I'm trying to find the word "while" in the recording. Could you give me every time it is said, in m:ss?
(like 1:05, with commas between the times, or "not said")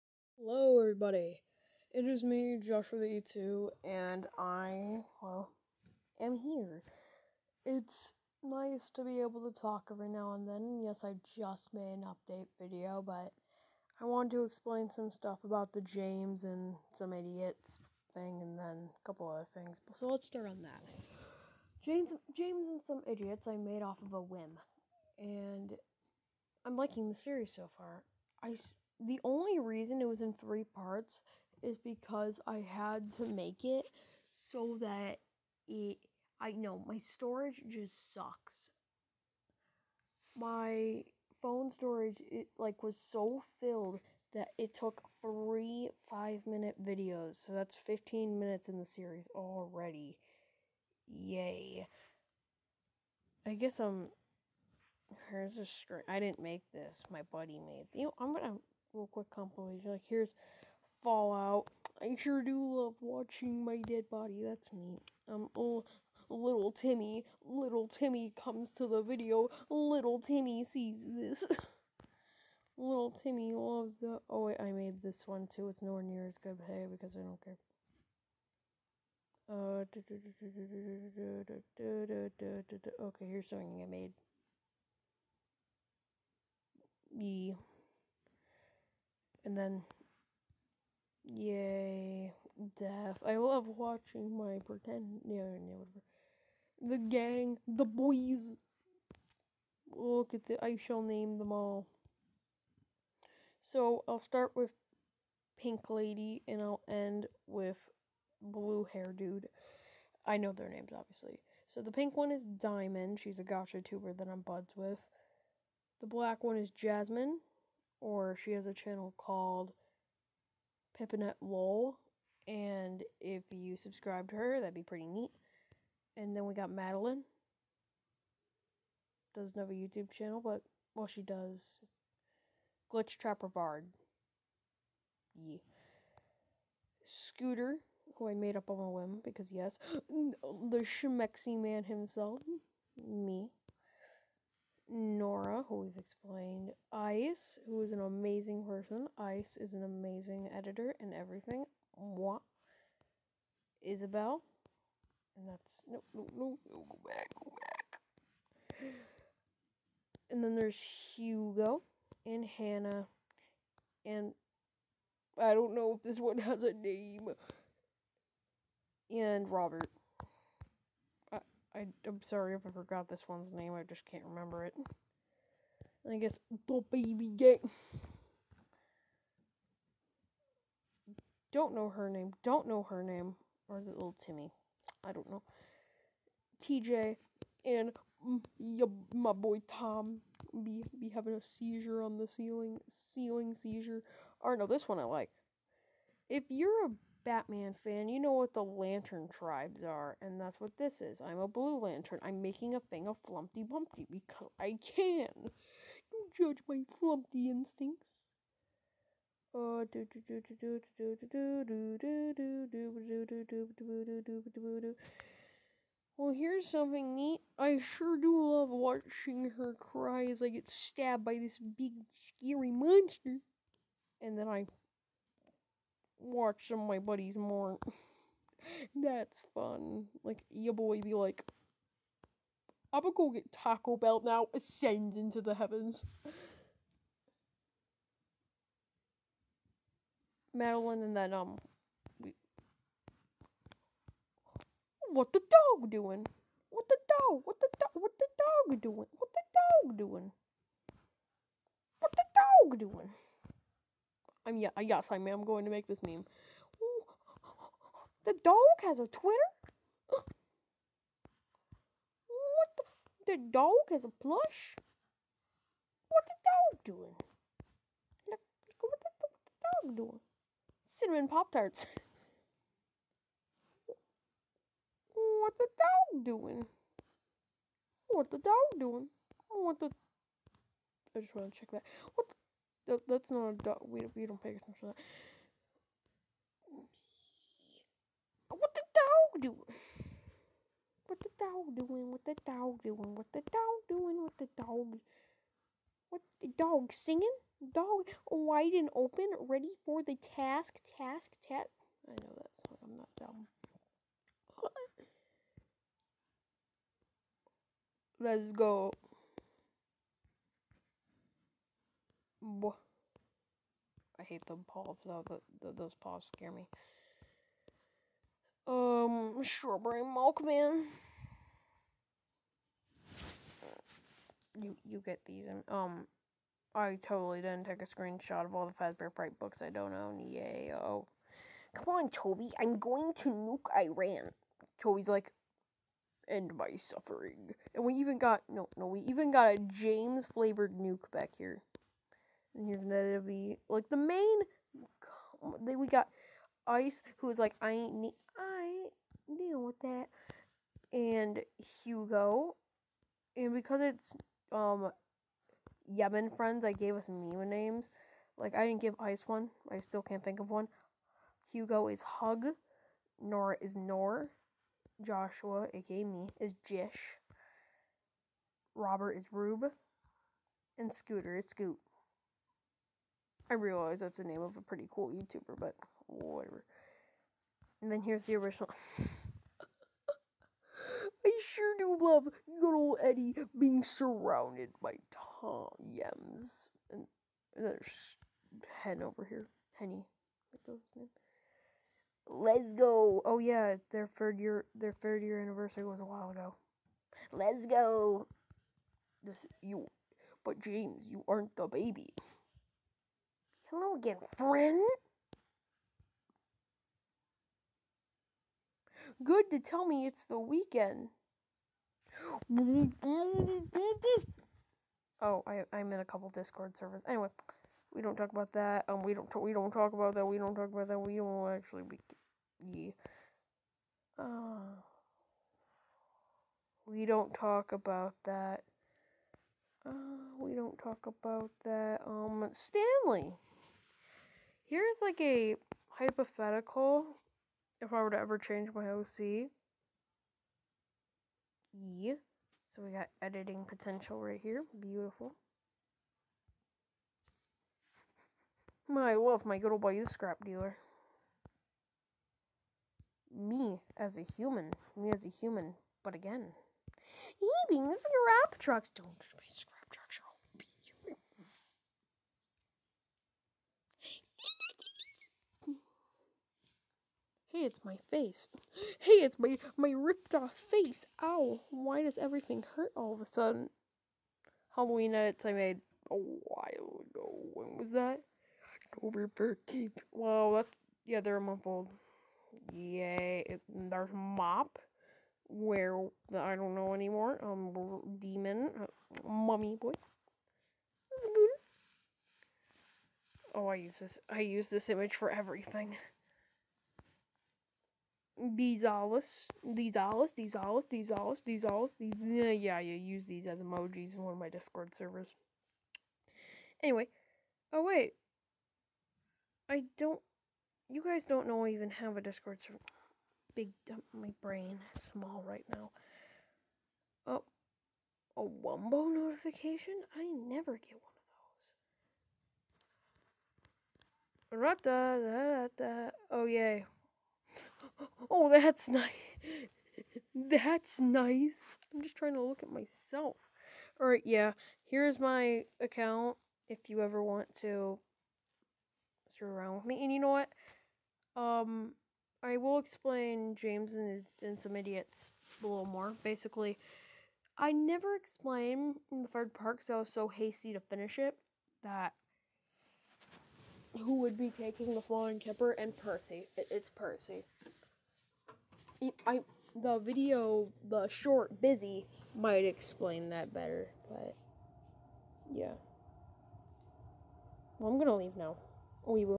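6:36, 7:56.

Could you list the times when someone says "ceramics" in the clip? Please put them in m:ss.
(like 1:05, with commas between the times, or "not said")
not said.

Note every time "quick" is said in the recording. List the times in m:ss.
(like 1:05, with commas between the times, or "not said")
0:59.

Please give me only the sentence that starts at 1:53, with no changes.
She's a gacha tuber that I'm buds with.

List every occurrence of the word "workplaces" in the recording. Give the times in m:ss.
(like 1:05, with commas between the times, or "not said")
not said.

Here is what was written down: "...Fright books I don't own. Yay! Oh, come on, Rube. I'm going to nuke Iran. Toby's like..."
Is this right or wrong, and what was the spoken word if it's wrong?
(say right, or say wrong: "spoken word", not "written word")
wrong: "Toby", not "Rube".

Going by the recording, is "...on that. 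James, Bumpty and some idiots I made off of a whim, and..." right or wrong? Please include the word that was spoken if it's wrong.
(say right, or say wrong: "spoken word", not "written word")
wrong: "James", not "Bumpty".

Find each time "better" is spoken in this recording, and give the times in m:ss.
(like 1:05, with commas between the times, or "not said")
9:23.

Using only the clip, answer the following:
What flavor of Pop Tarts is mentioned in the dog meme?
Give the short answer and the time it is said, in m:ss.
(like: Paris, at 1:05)
Cinnamon, at 4:30.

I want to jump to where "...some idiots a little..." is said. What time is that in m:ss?
9:04.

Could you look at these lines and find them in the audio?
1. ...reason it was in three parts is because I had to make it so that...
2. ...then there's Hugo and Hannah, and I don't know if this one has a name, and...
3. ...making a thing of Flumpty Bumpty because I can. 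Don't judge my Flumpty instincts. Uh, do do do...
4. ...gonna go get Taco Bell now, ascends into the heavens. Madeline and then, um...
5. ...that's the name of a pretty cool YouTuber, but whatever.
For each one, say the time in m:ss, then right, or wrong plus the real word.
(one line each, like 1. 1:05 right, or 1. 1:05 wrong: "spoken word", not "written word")
1. 0:29 right
2. 2:40 right
3. 3:22 right
4. 3:53 right
5. 6:13 right.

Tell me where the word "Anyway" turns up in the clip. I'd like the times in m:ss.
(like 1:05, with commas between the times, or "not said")
6:57, 8:26.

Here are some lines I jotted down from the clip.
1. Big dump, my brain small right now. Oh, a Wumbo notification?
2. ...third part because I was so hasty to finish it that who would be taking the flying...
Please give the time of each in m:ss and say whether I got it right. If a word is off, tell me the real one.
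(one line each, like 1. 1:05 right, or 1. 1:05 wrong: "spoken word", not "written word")
1. 8:33 right
2. 9:09 right.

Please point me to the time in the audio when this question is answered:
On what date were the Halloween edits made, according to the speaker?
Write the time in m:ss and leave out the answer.
7:58.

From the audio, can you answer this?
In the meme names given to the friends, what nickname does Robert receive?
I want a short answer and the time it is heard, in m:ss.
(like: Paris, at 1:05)
Rube, at 6:09.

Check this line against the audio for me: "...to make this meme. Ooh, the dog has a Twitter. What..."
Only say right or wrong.
right.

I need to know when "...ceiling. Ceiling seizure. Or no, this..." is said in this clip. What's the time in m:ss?
3:12.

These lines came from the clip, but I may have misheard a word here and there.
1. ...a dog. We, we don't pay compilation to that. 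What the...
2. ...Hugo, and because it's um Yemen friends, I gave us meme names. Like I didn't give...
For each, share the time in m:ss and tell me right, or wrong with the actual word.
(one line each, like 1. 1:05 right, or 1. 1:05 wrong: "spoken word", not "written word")
1. 4:43 wrong: "attention", not "compilation"
2. 5:51 right.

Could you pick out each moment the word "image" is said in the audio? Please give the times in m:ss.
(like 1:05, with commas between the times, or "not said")
8:14.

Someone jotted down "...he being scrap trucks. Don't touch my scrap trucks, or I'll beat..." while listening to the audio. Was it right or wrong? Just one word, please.
right.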